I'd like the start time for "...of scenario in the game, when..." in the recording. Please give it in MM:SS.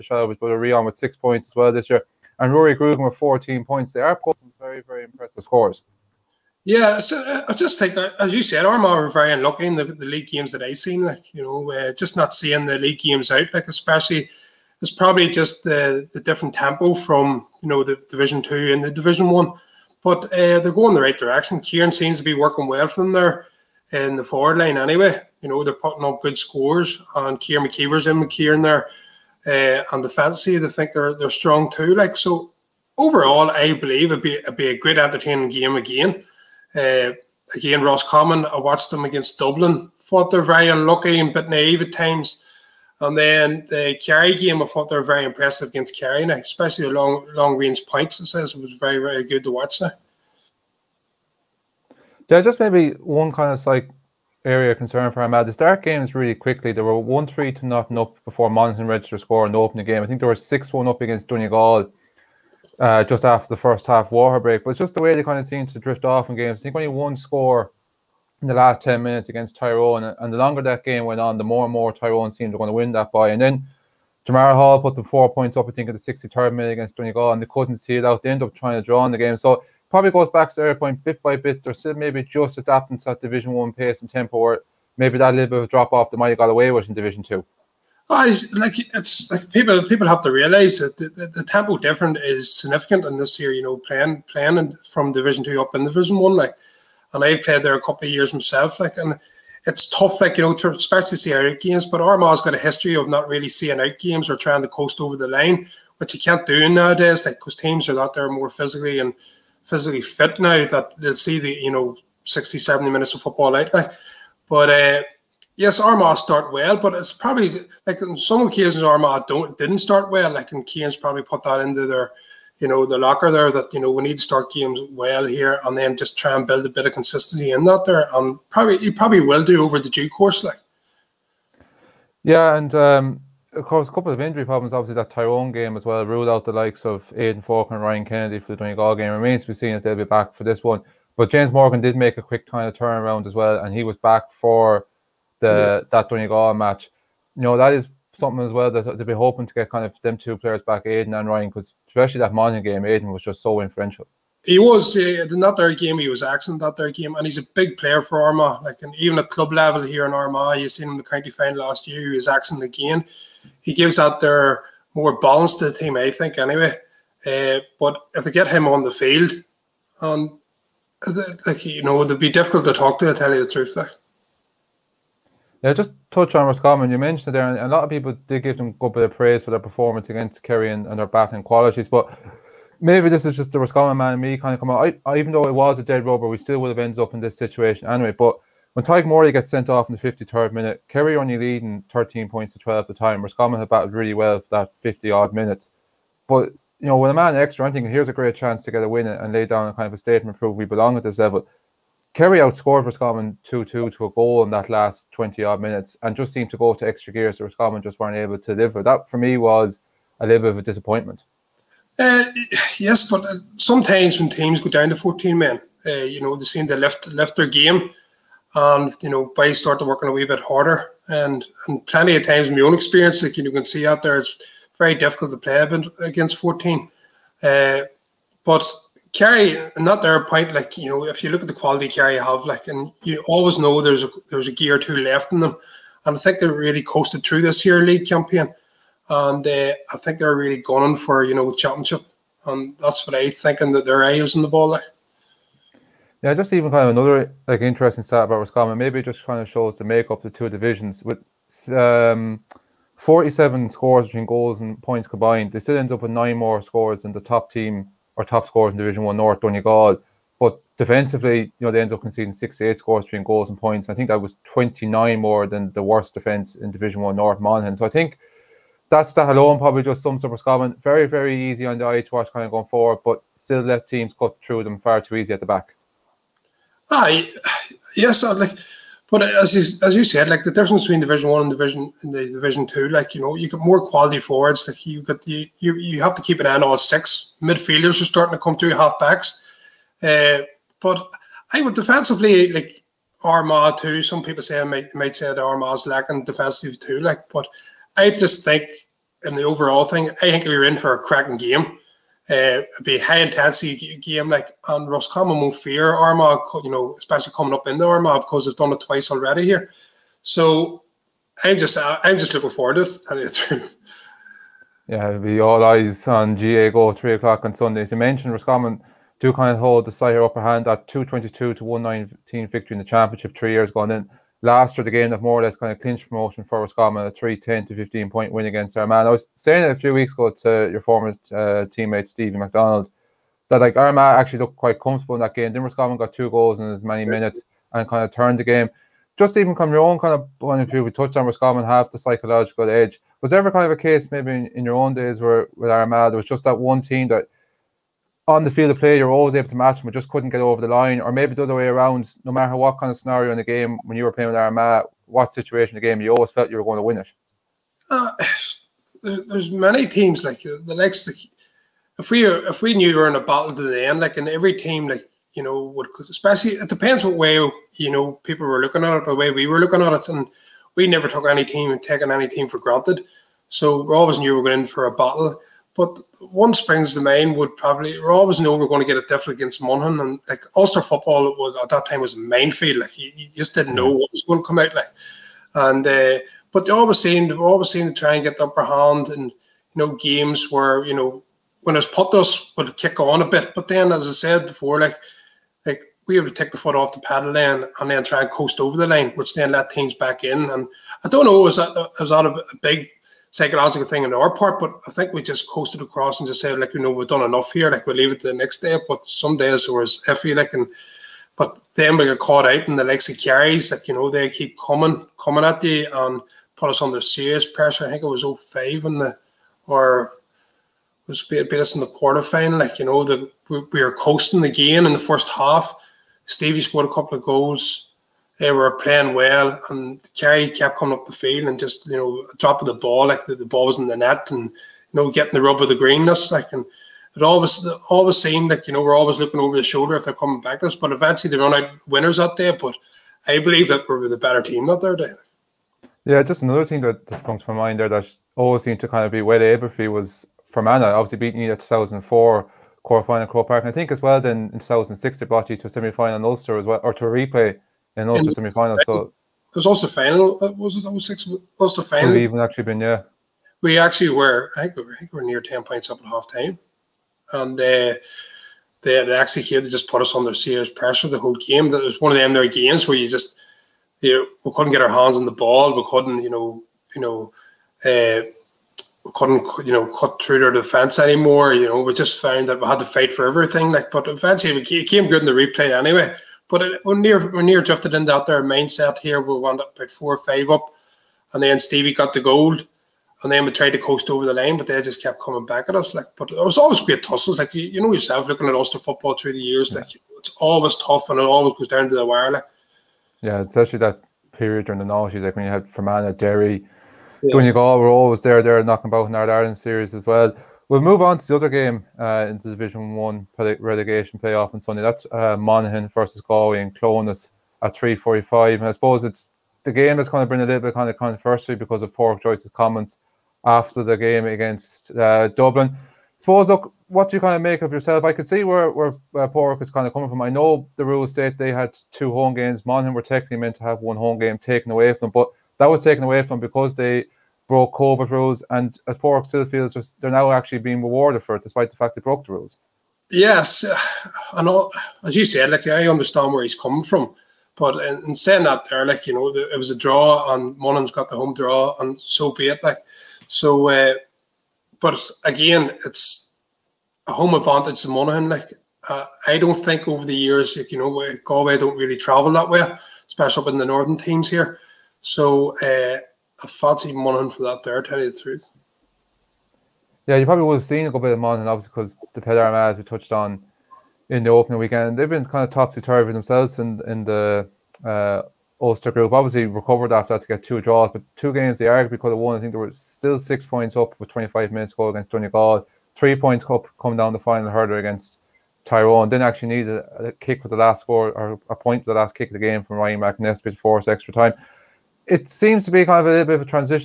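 05:52.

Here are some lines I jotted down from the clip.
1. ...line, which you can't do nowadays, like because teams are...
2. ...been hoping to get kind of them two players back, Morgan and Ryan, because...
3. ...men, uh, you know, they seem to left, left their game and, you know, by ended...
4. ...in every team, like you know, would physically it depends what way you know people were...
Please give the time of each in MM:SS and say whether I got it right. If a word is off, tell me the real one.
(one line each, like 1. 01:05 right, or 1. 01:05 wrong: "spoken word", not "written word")
1. 01:45 right
2. 02:29 wrong: "Aiden", not "Morgan"
3. 03:35 wrong: "started", not "ended"
4. 06:04 wrong: "especially", not "physically".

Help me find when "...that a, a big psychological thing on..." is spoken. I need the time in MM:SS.
06:42.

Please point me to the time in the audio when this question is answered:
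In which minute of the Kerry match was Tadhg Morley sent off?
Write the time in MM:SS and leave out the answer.
03:10.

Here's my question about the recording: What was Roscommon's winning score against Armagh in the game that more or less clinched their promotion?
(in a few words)
3-10.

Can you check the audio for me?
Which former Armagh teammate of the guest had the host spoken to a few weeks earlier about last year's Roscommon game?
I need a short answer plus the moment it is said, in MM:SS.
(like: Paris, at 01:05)
Steven McDonnell, at 05:32.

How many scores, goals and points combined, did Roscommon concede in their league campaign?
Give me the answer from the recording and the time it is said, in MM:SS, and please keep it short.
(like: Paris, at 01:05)
68, at 04:22.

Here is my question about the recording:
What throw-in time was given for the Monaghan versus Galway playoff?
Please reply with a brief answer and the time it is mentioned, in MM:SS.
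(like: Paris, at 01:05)
3:45, at 08:37.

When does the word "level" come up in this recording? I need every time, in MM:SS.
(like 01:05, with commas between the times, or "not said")
02:39, 03:21.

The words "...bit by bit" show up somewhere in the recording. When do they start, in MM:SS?
01:21.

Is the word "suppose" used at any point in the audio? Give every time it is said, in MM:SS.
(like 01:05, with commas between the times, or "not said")
08:38, 08:46.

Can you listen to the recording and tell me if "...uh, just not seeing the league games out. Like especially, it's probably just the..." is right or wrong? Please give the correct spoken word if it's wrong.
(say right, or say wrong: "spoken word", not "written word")
right.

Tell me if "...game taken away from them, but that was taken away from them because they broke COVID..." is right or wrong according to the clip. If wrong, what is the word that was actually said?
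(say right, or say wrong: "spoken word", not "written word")
right.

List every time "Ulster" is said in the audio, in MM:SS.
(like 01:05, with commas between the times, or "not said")
06:20, 07:36, 08:18, 09:38.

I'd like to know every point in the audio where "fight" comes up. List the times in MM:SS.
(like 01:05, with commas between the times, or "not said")
08:02.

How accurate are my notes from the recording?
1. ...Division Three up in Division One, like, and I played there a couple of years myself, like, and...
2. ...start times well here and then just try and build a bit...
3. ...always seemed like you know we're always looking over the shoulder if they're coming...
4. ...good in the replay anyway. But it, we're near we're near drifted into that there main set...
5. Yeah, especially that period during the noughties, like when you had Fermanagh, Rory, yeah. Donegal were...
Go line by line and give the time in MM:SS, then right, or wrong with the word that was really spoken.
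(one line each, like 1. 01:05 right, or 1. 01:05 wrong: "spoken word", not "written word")
1. 01:35 wrong: "Two", not "Three"
2. 02:04 wrong: "games", not "times"
3. 07:17 right
4. 08:05 right
5. 08:23 wrong: "Derry", not "Rory".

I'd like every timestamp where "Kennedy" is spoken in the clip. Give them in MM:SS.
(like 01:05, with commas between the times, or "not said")
02:18.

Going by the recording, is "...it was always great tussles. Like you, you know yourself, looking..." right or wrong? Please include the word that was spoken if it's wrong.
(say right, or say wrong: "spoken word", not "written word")
right.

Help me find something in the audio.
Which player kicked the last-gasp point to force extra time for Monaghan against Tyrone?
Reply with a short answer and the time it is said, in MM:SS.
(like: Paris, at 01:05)
Ryan McNess, at 09:52.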